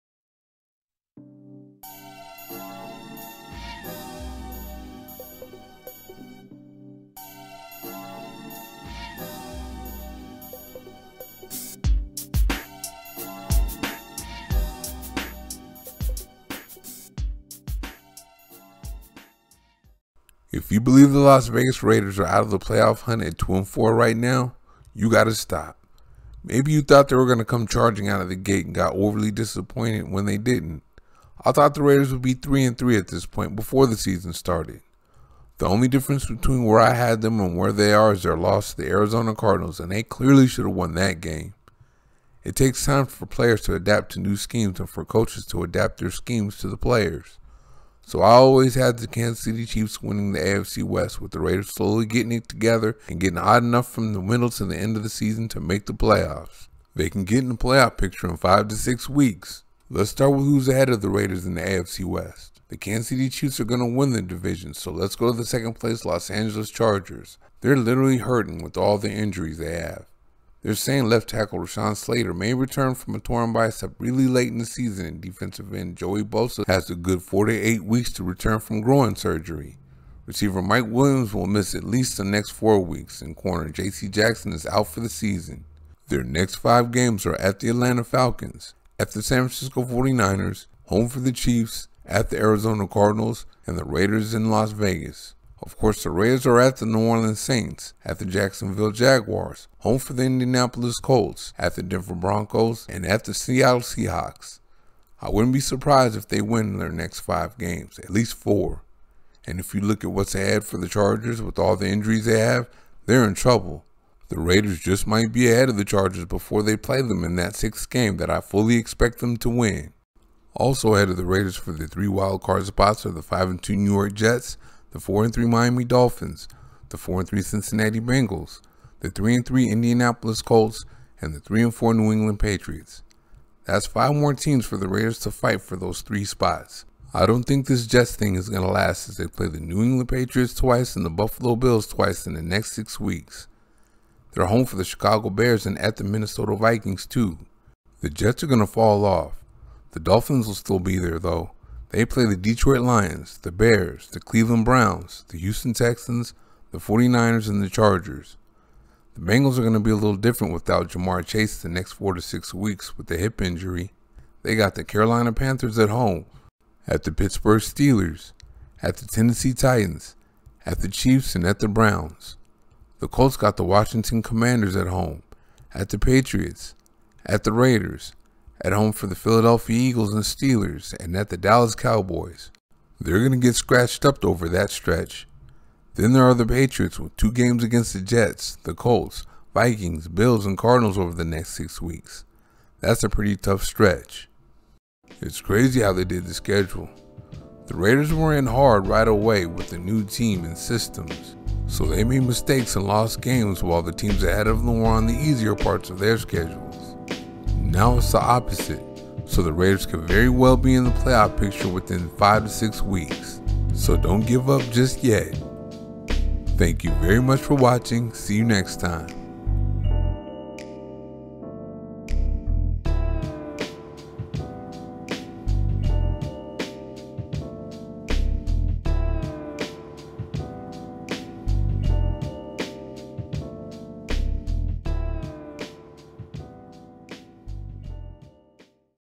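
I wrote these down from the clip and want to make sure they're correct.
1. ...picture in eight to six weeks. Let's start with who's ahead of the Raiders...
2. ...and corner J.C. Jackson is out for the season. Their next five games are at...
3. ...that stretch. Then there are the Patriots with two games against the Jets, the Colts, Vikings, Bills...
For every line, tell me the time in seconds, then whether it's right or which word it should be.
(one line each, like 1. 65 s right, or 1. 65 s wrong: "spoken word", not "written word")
1. 57 s wrong: "five", not "eight"
2. 83 s right
3. 184 s right.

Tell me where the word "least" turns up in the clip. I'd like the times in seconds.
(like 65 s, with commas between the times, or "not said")
81 s, 108 s.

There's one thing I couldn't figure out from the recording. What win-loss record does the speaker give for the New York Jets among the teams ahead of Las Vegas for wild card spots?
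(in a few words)
5 and 2.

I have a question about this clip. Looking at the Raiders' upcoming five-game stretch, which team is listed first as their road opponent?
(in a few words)
New Orleans Saints.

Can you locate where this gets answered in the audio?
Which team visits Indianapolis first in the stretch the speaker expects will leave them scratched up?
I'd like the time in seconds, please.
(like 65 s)
173 s.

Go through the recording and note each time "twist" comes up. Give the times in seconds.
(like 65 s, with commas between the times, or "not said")
not said.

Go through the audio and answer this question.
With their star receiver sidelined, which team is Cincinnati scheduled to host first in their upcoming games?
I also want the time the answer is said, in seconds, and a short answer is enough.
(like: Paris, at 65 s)
Carolina Panthers, at 164 s.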